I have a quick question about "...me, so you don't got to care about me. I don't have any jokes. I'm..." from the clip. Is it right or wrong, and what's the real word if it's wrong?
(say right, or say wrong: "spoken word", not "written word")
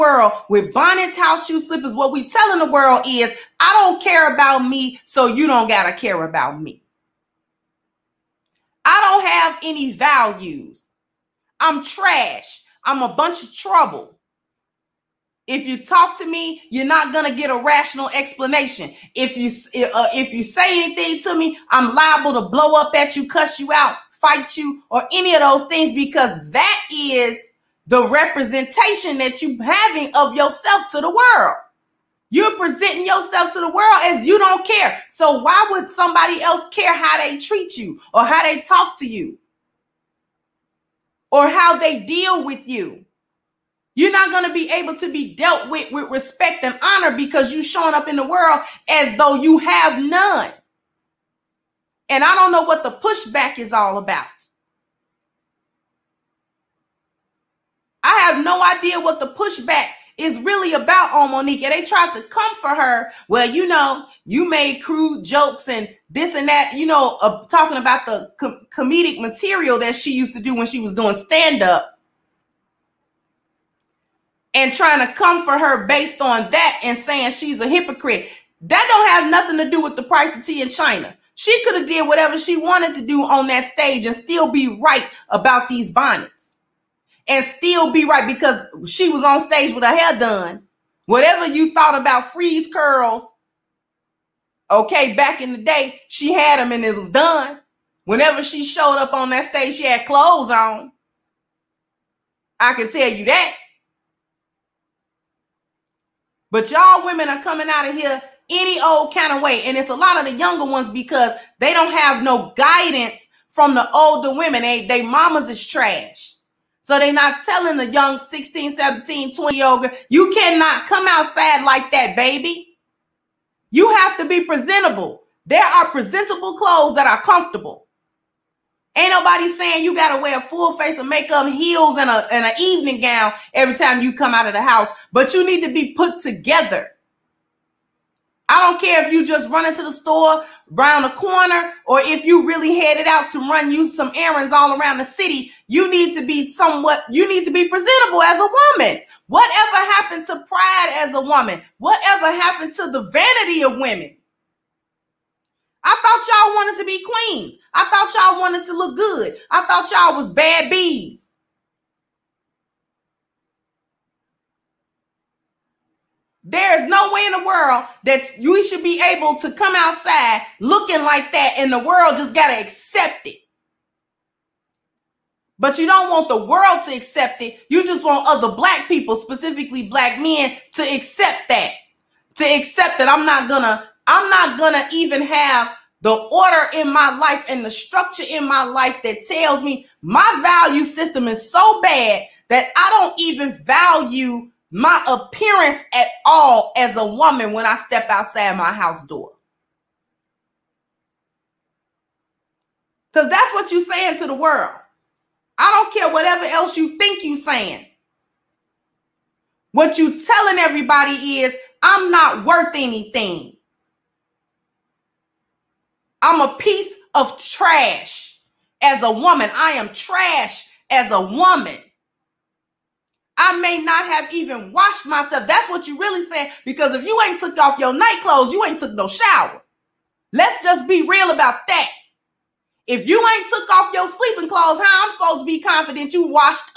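wrong: "values", not "jokes".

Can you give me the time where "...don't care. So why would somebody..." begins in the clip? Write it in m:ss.
0:34.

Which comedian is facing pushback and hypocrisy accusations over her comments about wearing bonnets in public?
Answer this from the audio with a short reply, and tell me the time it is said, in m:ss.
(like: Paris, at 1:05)
Monica, at 1:01.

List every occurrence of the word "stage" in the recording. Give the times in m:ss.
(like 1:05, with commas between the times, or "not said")
1:23, 1:29, 1:39.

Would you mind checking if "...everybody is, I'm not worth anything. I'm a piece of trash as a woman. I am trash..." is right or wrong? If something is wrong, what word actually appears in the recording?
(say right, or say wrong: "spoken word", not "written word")
right.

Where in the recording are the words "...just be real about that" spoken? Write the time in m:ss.
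3:50.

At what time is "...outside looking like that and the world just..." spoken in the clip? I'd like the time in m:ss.
2:49.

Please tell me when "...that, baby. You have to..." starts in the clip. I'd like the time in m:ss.
2:01.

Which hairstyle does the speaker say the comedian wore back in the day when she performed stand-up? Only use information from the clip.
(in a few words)
Freeze curls.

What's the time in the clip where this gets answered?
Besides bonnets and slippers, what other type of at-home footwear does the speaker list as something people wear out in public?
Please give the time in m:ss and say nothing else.
0:01.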